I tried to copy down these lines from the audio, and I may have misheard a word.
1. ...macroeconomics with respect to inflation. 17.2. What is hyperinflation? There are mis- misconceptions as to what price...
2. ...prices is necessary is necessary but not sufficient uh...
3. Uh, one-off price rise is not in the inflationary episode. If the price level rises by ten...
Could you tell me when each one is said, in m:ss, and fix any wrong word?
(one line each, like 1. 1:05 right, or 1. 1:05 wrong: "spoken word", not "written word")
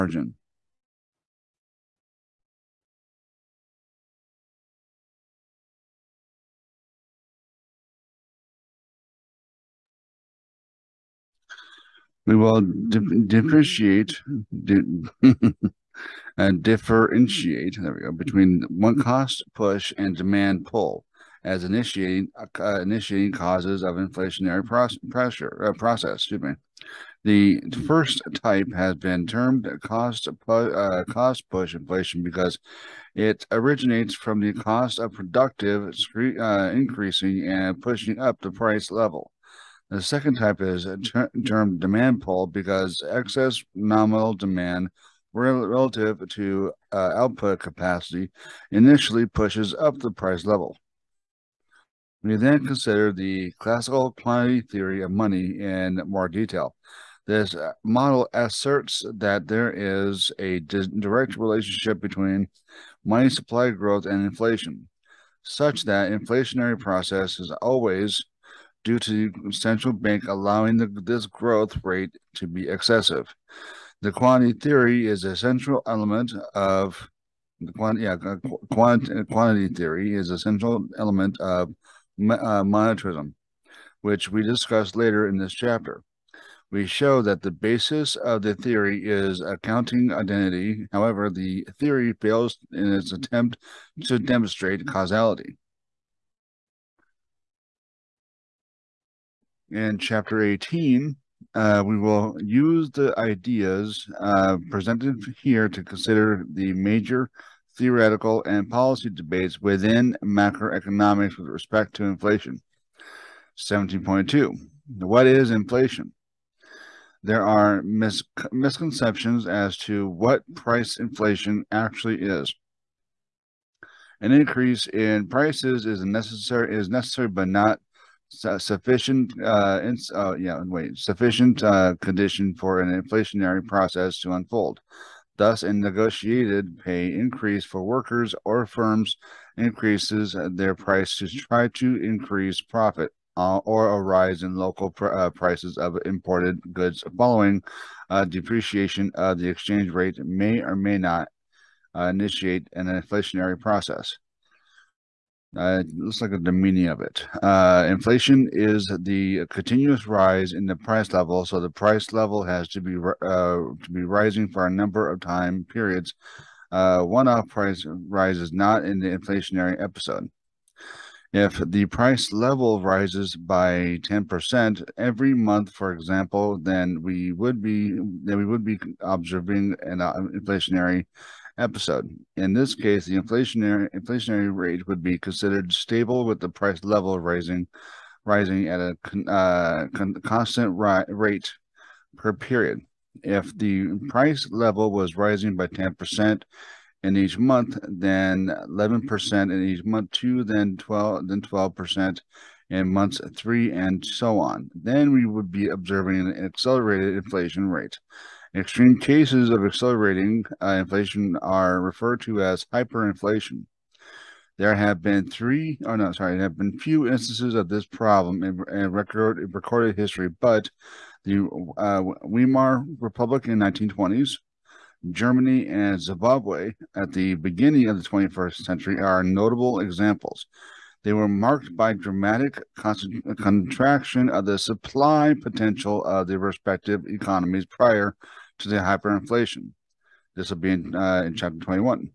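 1. 1:50 wrong: "inflation", not "hyperinflation"
2. 2:05 right
3. 2:46 right.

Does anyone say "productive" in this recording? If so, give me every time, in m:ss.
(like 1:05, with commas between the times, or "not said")
0:35.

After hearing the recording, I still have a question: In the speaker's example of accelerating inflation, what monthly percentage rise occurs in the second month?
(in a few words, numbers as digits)
11%.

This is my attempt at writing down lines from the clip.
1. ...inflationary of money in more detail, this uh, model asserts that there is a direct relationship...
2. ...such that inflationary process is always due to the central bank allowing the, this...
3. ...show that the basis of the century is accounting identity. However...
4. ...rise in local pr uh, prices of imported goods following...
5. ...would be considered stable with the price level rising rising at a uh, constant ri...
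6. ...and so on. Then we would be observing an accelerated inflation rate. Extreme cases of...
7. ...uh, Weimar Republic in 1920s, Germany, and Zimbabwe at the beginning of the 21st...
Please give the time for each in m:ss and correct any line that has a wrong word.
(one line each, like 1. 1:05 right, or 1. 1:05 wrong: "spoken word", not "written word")
1. 0:54 wrong: "theory", not "inflationary"
2. 1:05 right
3. 1:26 wrong: "theory", not "century"
4. 2:24 right
5. 3:04 right
6. 3:23 right
7. 3:41 right.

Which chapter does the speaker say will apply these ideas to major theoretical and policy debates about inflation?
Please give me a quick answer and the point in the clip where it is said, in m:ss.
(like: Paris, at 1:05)
Chapter 18, at 1:39.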